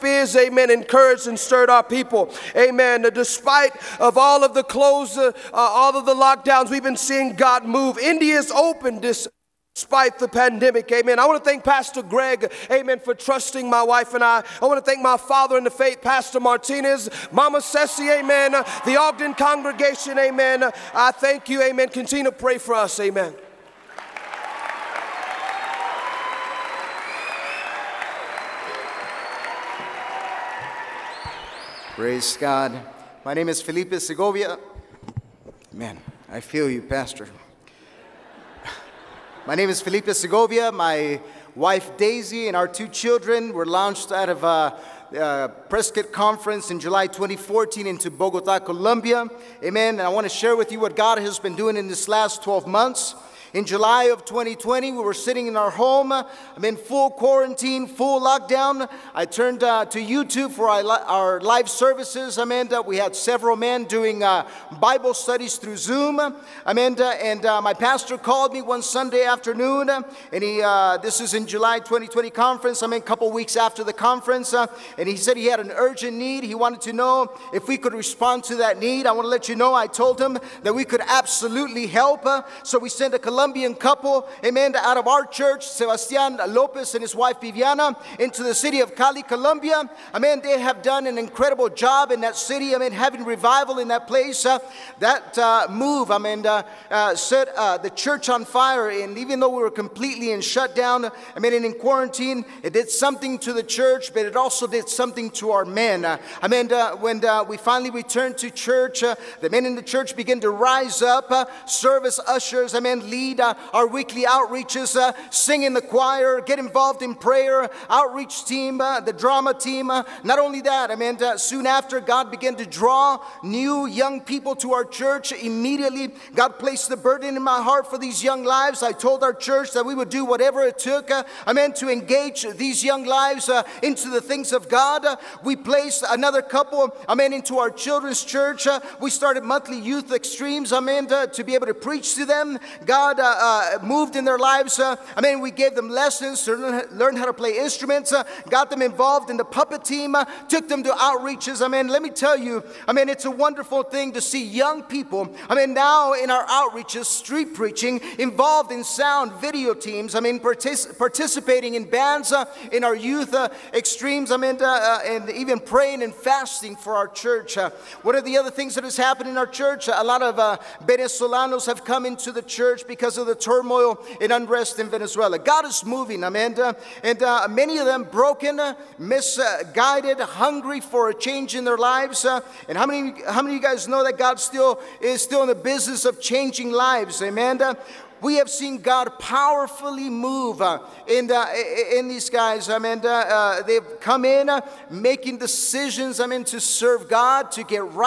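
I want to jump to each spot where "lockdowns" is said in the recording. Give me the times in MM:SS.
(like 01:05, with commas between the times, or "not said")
00:06, 00:58.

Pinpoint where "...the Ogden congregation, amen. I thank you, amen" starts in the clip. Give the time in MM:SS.
00:18.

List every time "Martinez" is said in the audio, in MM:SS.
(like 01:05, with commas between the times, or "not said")
00:16.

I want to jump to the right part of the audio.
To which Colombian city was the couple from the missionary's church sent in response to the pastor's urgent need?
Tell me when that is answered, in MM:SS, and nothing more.
01:28.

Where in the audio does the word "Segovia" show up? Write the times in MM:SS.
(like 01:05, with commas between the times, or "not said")
00:33, 00:40.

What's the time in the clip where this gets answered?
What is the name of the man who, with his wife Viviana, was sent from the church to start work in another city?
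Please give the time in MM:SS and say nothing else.
01:25.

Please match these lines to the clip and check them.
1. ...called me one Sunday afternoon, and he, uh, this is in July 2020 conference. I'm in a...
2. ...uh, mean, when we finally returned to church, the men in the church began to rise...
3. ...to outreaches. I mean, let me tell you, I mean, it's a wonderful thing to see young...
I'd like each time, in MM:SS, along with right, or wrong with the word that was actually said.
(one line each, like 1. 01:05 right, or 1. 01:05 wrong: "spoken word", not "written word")
1. 01:08 right
2. 01:46 right
3. 02:30 right.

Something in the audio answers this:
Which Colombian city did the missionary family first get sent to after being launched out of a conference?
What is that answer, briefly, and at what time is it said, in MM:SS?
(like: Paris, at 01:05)
Bogota, at 00:48.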